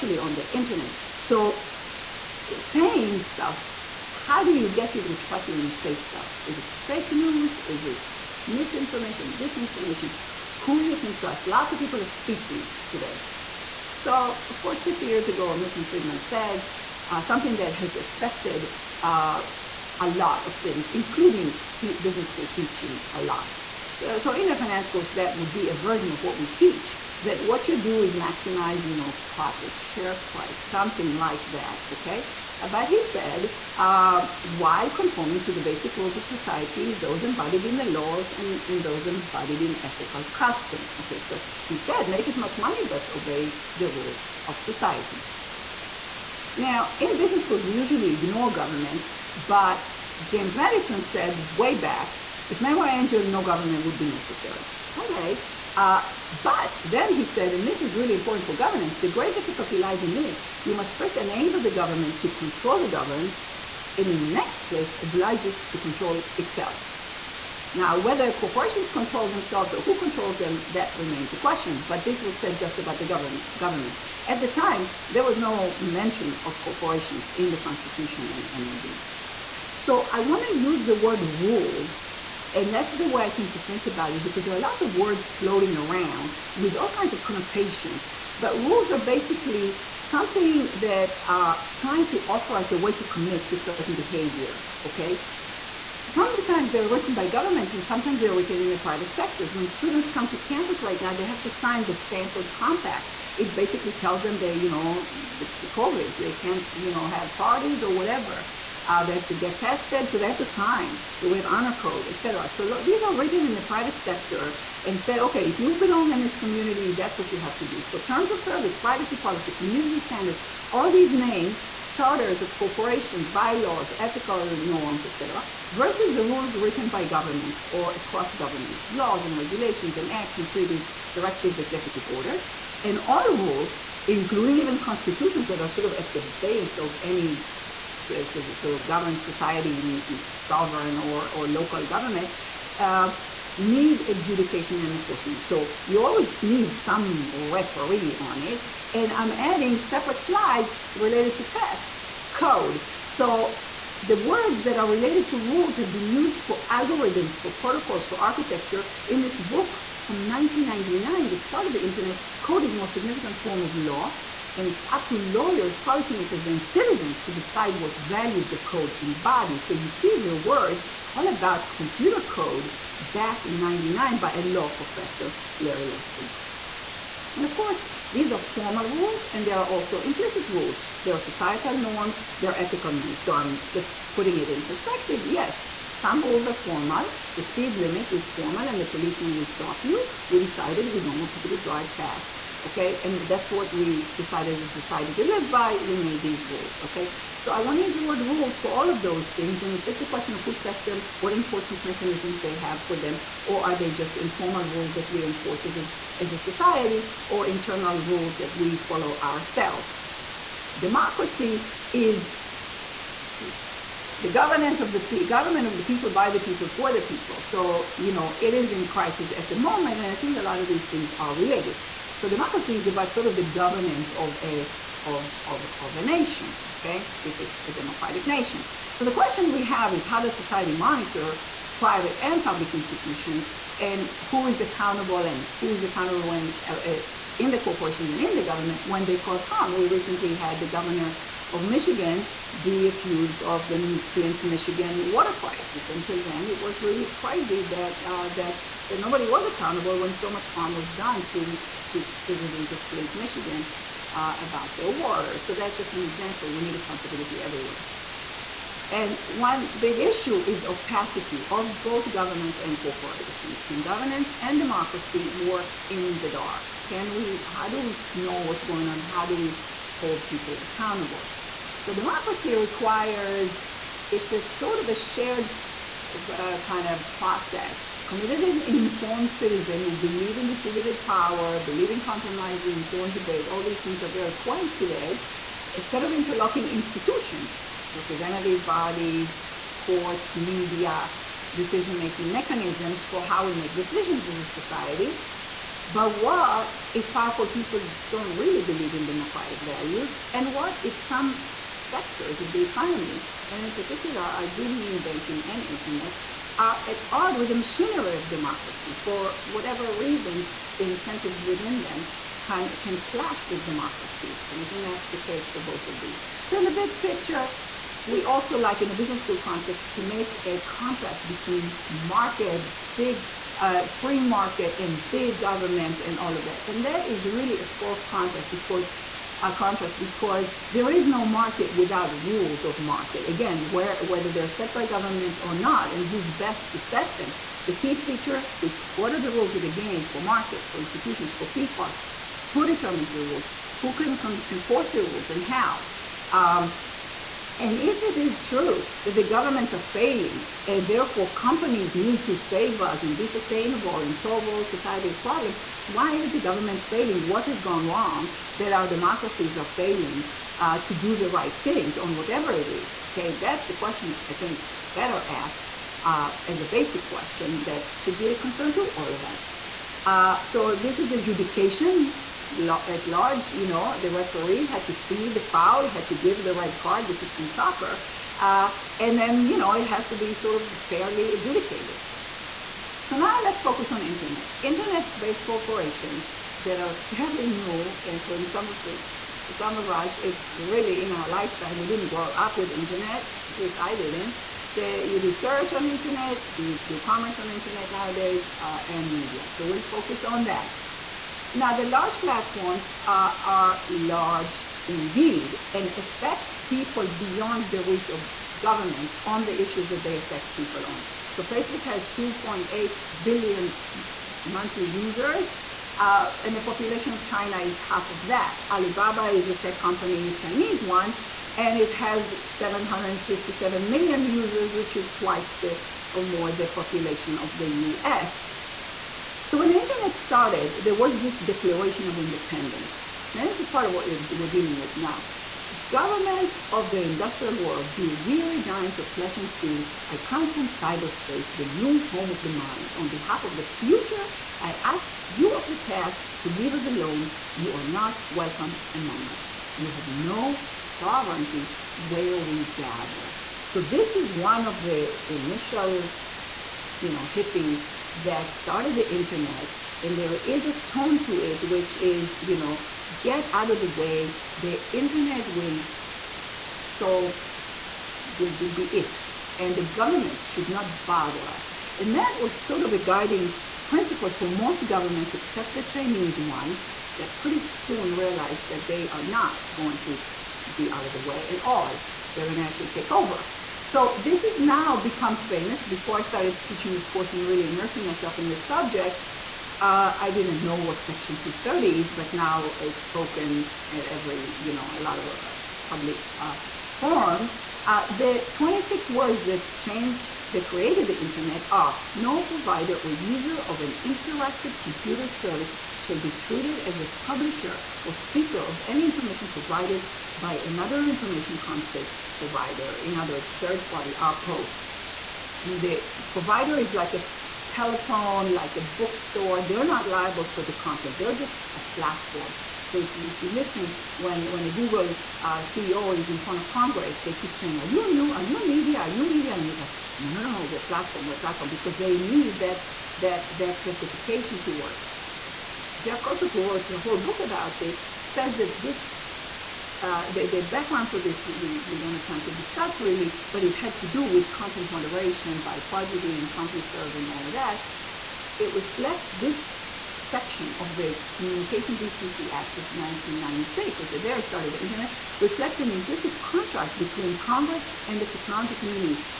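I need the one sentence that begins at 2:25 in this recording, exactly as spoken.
So you always need some referee on it.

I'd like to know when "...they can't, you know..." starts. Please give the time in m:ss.
1:46.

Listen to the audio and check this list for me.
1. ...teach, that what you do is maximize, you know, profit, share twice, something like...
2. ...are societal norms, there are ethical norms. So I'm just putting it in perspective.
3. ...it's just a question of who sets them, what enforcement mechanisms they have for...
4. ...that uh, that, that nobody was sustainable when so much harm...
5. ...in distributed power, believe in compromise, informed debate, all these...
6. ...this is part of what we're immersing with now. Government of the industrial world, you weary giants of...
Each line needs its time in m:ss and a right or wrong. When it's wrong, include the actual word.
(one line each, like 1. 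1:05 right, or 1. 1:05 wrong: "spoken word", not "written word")
1. 0:26 wrong: "price", not "twice"
2. 3:01 right
3. 3:19 right
4. 4:07 wrong: "accountable", not "sustainable"
5. 4:40 right
6. 7:13 wrong: "dealing", not "immersing".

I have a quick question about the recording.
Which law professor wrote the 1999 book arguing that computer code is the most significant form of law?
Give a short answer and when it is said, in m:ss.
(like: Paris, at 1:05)
Larry Lessig, at 2:55.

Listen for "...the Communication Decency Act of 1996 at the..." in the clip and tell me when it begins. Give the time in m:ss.
9:10.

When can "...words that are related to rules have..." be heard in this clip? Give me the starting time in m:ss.
2:34.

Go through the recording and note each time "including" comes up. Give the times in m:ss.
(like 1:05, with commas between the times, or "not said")
0:20, 2:14.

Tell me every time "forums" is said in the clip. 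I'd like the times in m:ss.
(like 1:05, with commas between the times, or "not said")
8:16.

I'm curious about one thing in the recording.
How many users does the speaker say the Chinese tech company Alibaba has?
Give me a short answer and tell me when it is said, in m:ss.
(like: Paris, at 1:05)
757 million, at 7:02.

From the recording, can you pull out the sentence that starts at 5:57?
What has gone wrong that our democracies are failing uh, to do the right things on whatever it is?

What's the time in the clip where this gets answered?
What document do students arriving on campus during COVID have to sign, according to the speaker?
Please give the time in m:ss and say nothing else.
1:41.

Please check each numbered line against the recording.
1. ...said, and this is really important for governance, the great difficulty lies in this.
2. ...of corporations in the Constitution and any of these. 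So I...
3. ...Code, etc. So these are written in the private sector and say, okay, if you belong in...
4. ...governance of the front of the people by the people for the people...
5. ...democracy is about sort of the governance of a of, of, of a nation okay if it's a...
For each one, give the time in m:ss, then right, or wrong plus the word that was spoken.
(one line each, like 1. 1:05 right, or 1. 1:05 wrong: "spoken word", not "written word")
1. 0:57 right
2. 1:16 right
3. 1:51 right
4. 3:34 wrong: "government", not "front"
5. 3:42 right.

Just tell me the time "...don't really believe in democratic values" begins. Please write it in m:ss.
4:58.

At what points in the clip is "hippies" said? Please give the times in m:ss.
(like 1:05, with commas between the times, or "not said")
7:37.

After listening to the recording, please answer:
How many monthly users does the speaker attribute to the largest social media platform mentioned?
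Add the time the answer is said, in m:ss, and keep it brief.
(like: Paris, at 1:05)
2.8 billion, at 6:52.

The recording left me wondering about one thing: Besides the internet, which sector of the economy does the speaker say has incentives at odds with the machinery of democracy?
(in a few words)
banking.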